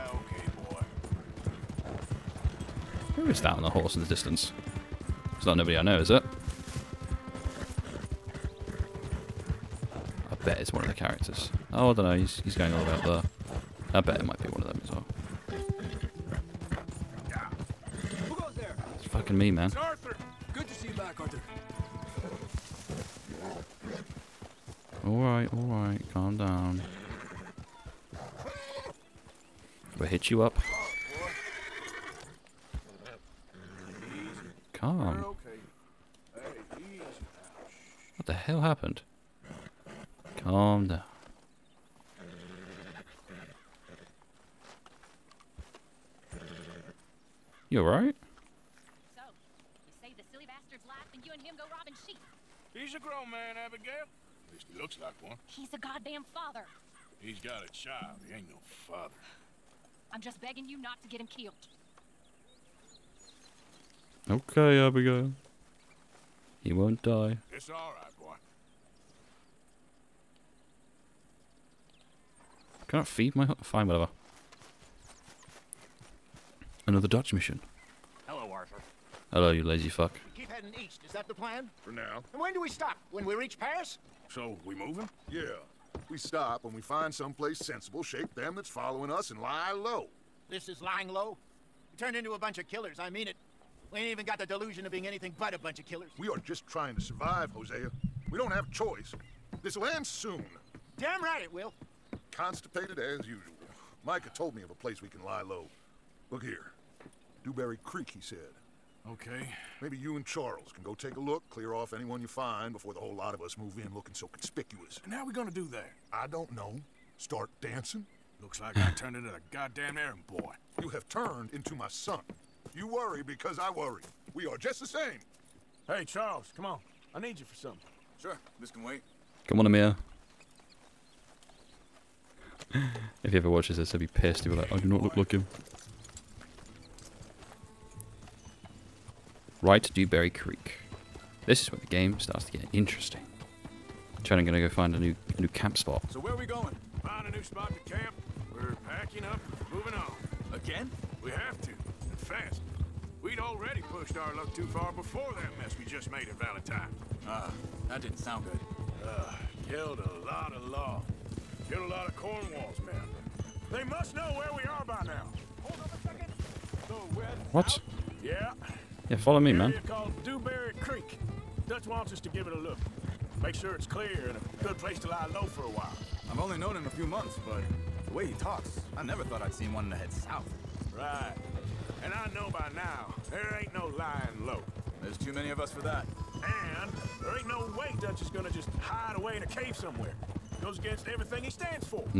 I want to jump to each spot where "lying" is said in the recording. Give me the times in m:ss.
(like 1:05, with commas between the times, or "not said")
1:30, 3:03.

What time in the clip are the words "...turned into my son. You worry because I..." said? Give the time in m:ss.
2:01.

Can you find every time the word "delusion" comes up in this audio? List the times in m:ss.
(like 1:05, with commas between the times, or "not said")
1:34.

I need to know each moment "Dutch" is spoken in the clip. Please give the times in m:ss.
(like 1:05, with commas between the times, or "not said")
1:17, 2:51, 3:08.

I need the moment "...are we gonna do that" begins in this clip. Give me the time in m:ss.
1:55.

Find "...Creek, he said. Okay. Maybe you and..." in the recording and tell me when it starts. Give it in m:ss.
1:47.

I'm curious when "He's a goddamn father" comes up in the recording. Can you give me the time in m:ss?
0:55.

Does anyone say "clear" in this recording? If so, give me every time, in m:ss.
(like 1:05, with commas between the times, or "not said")
1:51, 2:53.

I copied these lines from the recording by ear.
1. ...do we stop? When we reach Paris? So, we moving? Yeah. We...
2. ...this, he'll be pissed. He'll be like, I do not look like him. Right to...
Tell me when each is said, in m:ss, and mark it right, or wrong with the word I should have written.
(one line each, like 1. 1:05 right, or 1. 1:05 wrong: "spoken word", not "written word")
1. 1:22 right
2. 2:13 right.